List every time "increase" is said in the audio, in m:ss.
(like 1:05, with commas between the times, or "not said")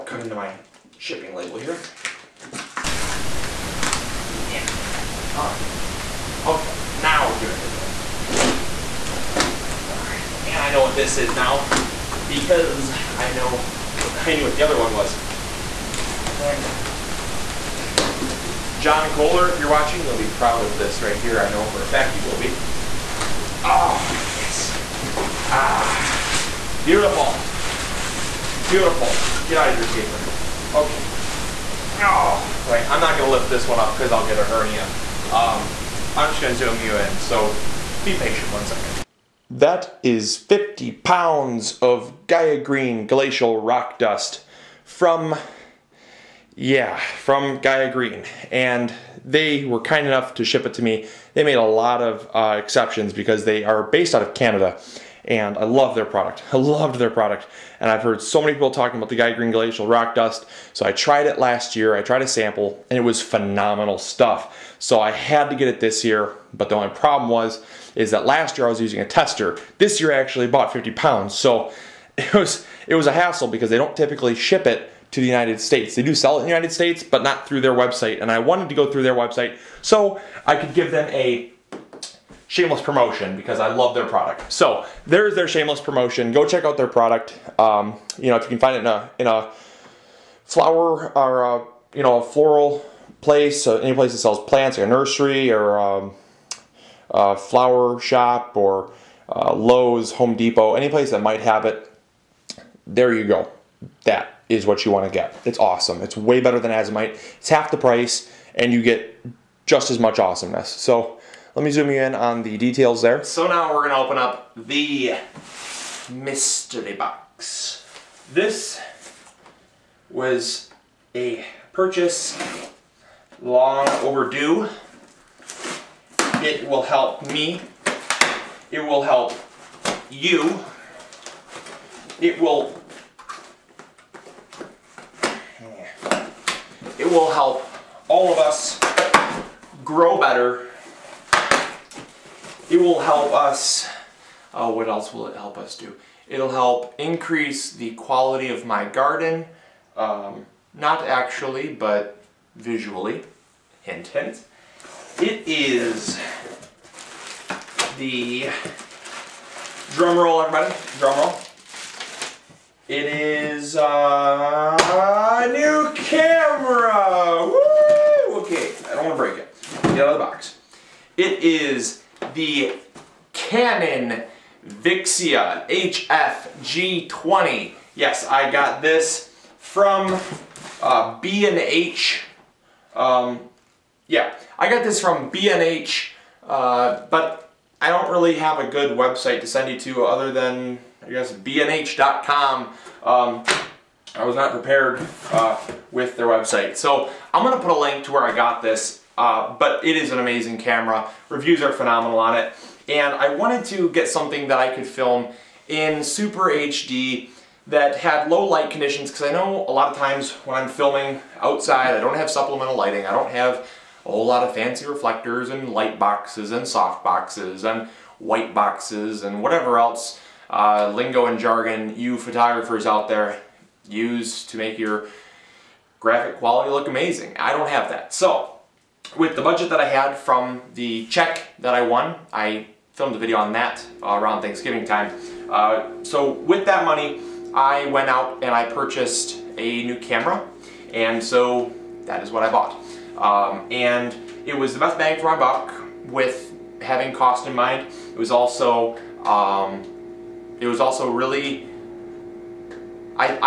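2:26.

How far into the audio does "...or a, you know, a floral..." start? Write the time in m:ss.
1:31.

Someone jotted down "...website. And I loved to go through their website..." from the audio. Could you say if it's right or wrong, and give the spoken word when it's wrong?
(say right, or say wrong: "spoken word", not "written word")
wrong: "wanted", not "loved".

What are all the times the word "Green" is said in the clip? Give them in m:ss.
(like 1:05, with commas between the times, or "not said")
0:42, 0:47, 0:59.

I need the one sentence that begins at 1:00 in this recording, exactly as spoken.
So I tried it last year, I tried a sample, and it was phenomenal stuff.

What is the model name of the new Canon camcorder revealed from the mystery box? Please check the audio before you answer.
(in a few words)
Vixia HF-G20.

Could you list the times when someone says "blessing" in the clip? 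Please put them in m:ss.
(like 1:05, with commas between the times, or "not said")
not said.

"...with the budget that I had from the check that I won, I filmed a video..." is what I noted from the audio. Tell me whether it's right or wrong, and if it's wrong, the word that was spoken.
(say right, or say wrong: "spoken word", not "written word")
right.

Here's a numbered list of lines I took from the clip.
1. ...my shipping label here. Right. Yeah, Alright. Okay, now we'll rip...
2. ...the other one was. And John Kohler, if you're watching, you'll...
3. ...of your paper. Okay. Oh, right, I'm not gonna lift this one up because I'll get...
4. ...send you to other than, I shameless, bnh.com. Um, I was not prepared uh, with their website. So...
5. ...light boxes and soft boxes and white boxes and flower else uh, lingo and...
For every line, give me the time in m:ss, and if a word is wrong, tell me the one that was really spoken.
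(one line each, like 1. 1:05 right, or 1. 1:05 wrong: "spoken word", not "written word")
1. 0:00 right
2. 0:14 right
3. 0:29 right
4. 3:09 wrong: "guess", not "shameless"
5. 3:35 wrong: "whatever", not "flower".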